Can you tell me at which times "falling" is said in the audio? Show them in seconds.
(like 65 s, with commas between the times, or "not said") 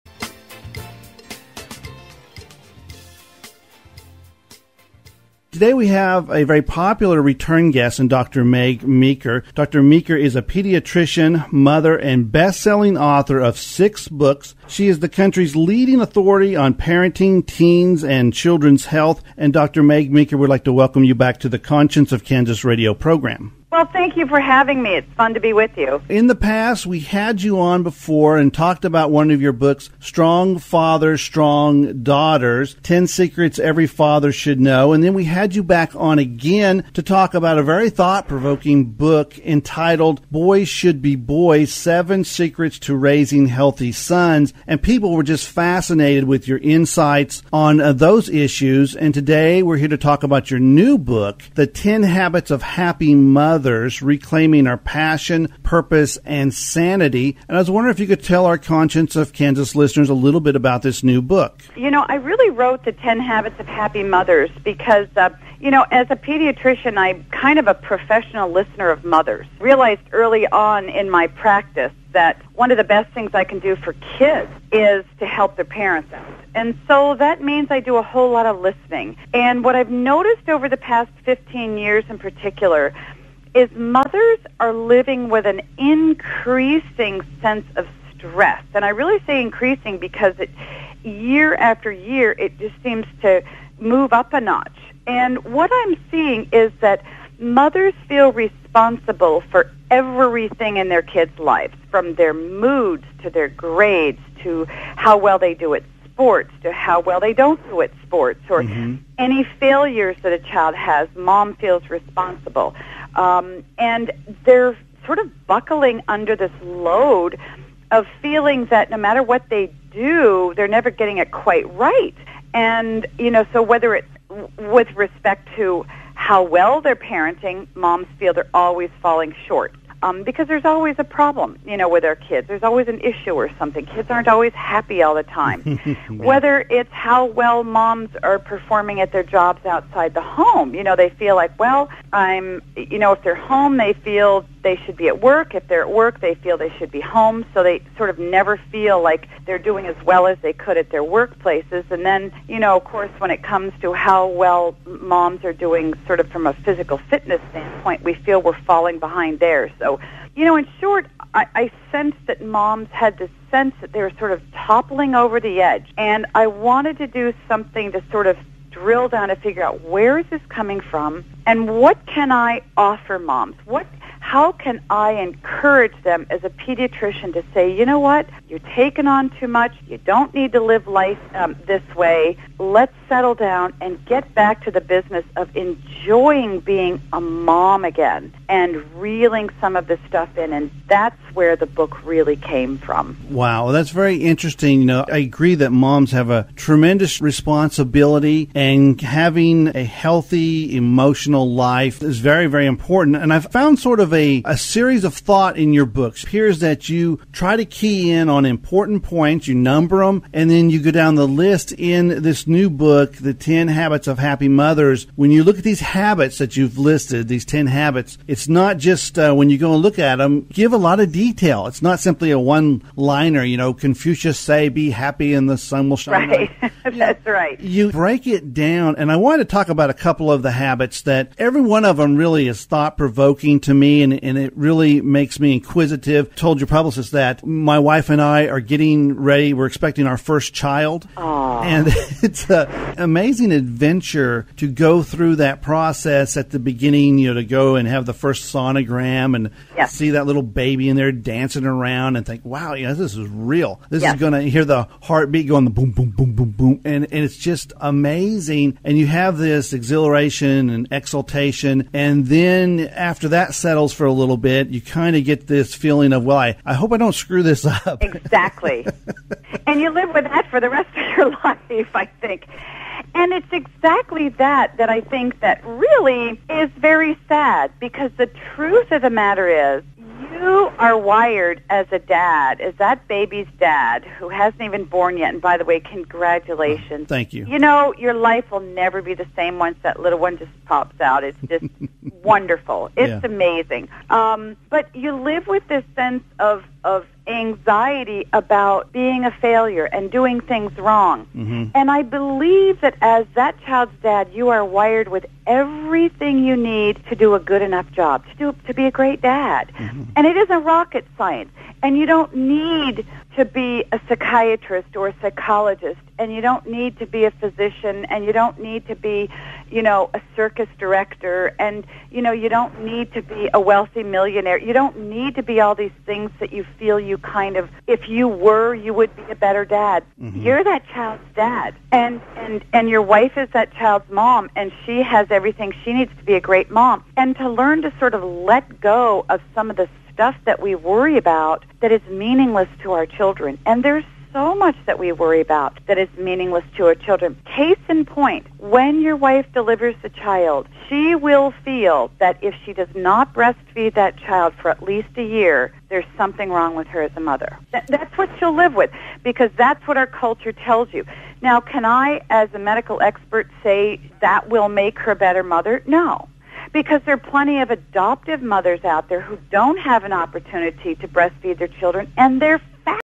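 129 s, 158 s.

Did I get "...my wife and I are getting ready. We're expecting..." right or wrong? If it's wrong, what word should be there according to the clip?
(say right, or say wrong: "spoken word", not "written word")
right.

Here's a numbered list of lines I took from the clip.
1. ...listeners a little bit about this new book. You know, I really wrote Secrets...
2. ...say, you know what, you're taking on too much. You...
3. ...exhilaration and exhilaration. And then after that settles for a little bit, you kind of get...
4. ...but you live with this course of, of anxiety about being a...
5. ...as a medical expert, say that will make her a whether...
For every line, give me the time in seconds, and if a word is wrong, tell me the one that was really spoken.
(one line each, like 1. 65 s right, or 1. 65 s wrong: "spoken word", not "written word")
1. 59 s wrong: "The", not "Secrets"
2. 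177 s right
3. 259 s wrong: "exultation", not "exhilaration"
4. 294 s wrong: "sense", not "course"
5. 362 s wrong: "better", not "whether".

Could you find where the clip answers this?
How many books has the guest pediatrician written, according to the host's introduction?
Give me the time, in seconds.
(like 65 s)
13 s.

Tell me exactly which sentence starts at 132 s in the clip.
There's always an issue or something.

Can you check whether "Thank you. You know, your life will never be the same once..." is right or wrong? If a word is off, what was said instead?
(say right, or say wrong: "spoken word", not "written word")
right.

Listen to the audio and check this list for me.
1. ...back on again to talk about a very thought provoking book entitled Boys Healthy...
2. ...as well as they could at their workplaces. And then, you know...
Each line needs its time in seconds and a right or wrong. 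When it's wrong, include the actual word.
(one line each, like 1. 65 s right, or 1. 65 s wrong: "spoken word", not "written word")
1. 35 s wrong: "Should", not "Healthy"
2. 149 s right.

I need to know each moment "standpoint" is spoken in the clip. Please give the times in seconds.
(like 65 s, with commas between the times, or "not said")
157 s.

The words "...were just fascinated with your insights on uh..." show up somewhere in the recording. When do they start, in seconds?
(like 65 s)
45 s.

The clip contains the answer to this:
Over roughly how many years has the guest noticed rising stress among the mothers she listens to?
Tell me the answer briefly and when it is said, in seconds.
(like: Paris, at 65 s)
15 years, at 81 s.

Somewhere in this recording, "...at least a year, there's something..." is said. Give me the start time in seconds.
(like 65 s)
354 s.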